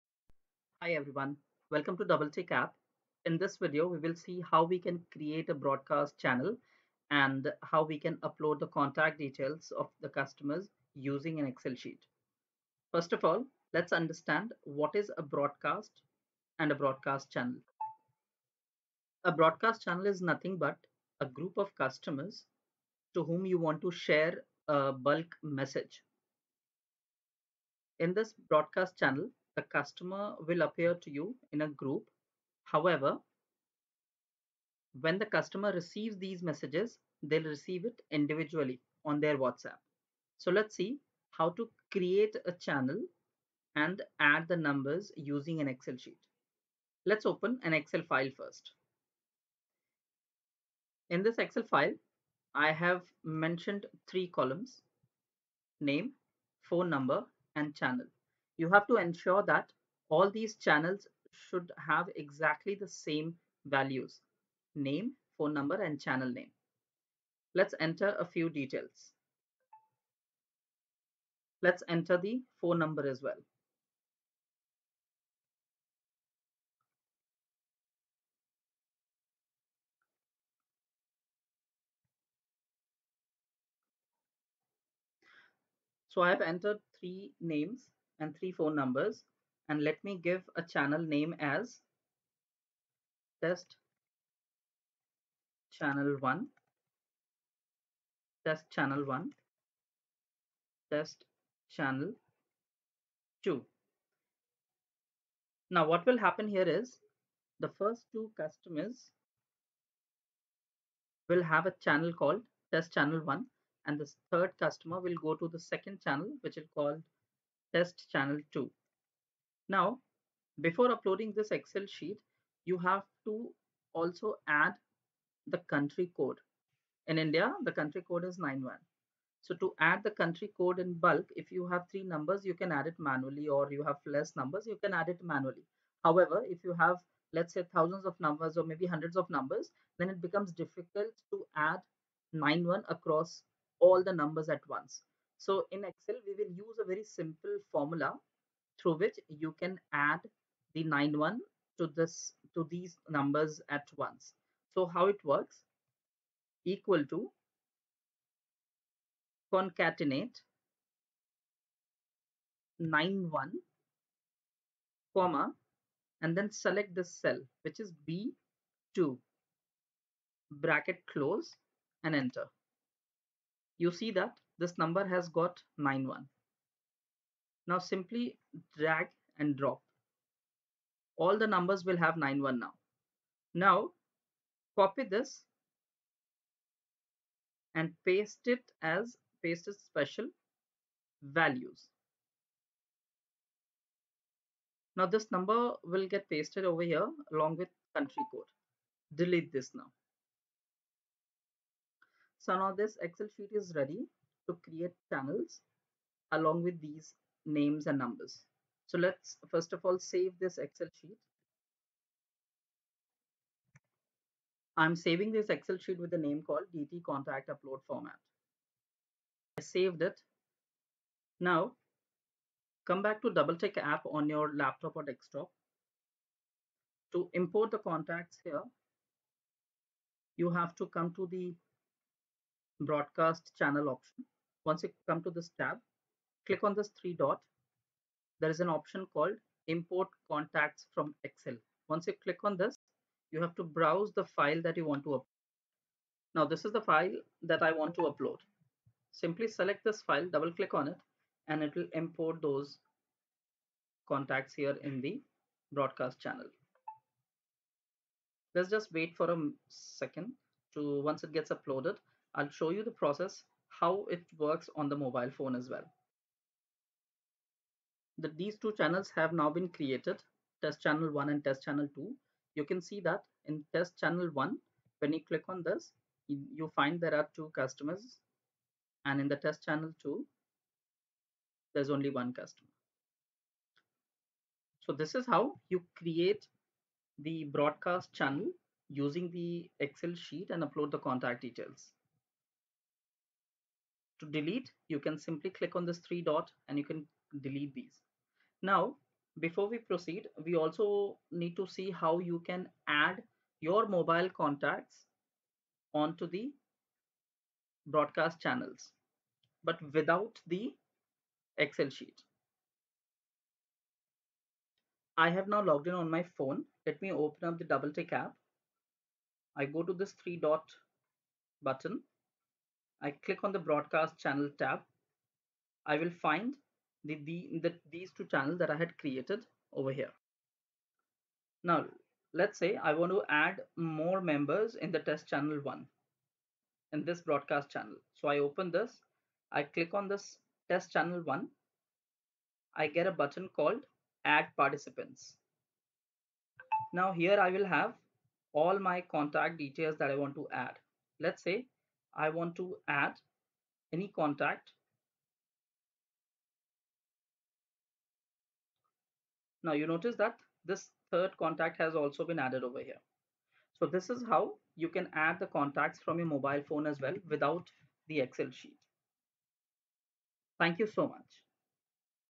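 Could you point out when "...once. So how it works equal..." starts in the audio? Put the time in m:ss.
2:33.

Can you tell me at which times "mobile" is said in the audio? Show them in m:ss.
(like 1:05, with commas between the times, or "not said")
4:24, 5:03, 6:06.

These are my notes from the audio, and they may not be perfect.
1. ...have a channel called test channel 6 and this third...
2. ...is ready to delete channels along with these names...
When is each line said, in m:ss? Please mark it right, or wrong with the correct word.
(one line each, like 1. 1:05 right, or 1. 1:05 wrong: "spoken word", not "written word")
1. 1:51 wrong: "1", not "6"
2. 3:23 wrong: "create", not "delete".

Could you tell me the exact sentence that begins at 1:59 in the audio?
Now, before uploading this Excel sheet, you have to also add the country code.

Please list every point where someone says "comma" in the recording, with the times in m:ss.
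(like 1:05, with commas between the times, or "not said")
2:45.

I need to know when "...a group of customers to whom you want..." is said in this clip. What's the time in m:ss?
0:21.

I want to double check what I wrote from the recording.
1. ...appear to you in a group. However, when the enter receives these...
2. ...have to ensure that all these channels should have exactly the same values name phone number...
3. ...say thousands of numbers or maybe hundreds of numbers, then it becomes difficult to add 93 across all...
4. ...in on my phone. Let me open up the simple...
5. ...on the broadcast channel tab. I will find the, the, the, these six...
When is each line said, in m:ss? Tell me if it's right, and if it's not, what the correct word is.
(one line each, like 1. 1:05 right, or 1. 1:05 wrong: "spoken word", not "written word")
1. 0:30 wrong: "customer", not "enter"
2. 0:58 right
3. 2:17 wrong: "91", not "93"
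4. 5:15 wrong: "double", not "simple"
5. 5:23 wrong: "two", not "six".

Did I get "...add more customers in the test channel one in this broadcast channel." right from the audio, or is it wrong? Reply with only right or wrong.
wrong.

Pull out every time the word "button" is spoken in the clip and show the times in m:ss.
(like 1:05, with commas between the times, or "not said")
5:21, 5:43.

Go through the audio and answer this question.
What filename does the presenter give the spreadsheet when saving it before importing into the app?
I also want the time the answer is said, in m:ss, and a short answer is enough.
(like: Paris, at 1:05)
DT contact upload format, at 3:36.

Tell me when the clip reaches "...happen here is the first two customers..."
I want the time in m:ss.
1:46.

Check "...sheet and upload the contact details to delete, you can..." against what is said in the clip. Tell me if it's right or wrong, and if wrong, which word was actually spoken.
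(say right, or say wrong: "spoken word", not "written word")
right.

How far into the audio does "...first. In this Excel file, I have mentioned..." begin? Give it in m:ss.
0:48.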